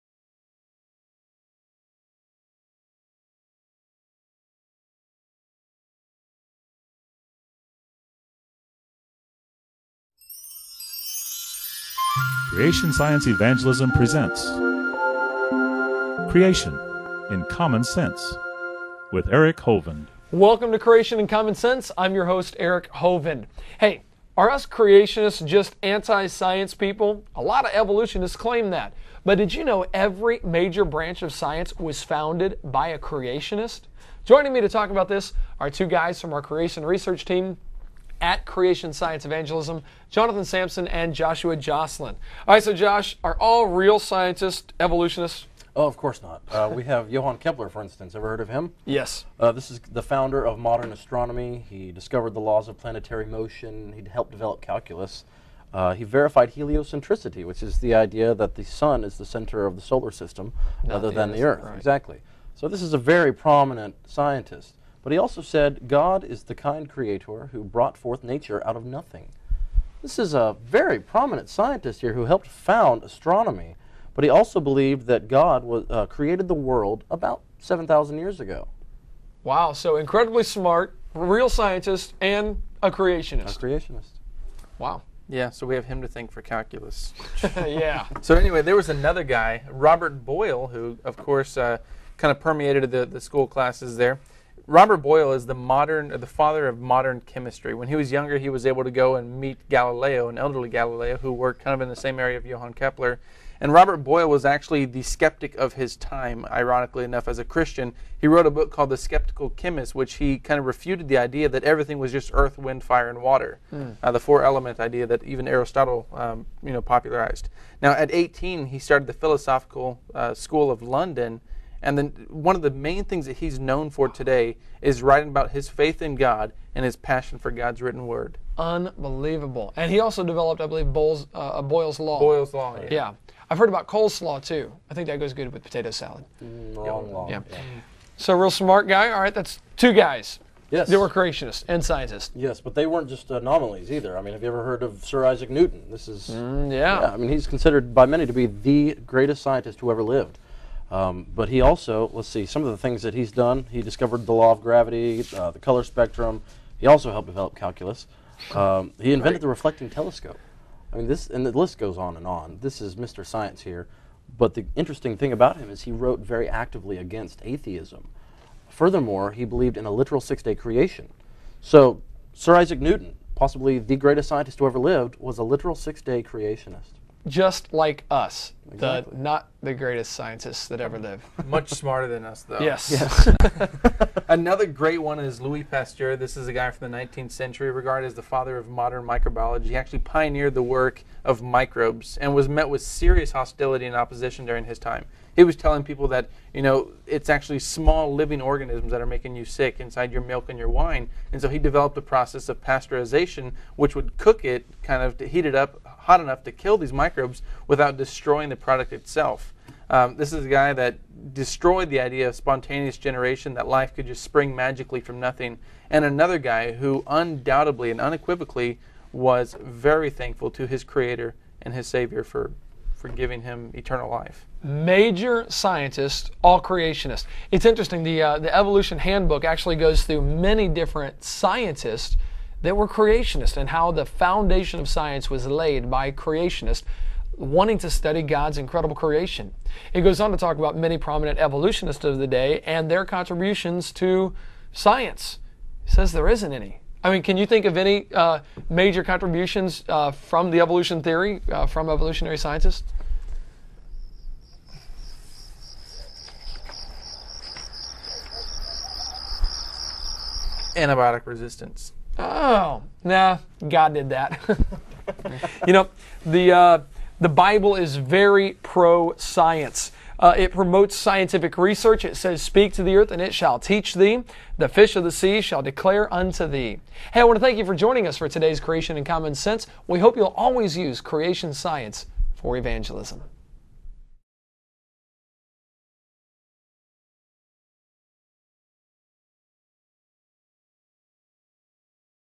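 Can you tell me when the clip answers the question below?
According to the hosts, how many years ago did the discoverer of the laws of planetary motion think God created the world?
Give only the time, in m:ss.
1:17.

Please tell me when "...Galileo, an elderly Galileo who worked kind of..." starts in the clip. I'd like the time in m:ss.
1:39.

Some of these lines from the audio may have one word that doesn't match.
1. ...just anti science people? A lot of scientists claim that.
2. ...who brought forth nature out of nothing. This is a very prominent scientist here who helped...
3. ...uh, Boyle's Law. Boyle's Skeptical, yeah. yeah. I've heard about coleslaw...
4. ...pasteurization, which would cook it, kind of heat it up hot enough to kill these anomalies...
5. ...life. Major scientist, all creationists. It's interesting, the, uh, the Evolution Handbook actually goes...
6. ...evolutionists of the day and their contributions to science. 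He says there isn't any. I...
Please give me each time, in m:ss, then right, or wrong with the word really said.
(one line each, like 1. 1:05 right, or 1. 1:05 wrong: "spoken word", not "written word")
1. 0:25 wrong: "evolutionists", not "scientists"
2. 1:07 right
3. 2:11 wrong: "Law", not "Skeptical"
4. 3:22 wrong: "microbes", not "anomalies"
5. 3:44 right
6. 4:01 right.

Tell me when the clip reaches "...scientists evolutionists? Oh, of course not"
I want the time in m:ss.
0:43.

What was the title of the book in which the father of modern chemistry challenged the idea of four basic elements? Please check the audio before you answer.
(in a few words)
The Skeptical Chemist.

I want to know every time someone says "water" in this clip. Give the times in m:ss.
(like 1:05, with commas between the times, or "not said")
1:53.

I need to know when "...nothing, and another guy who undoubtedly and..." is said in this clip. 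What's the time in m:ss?
3:35.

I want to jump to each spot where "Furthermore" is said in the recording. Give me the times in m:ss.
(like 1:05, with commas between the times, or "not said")
2:48.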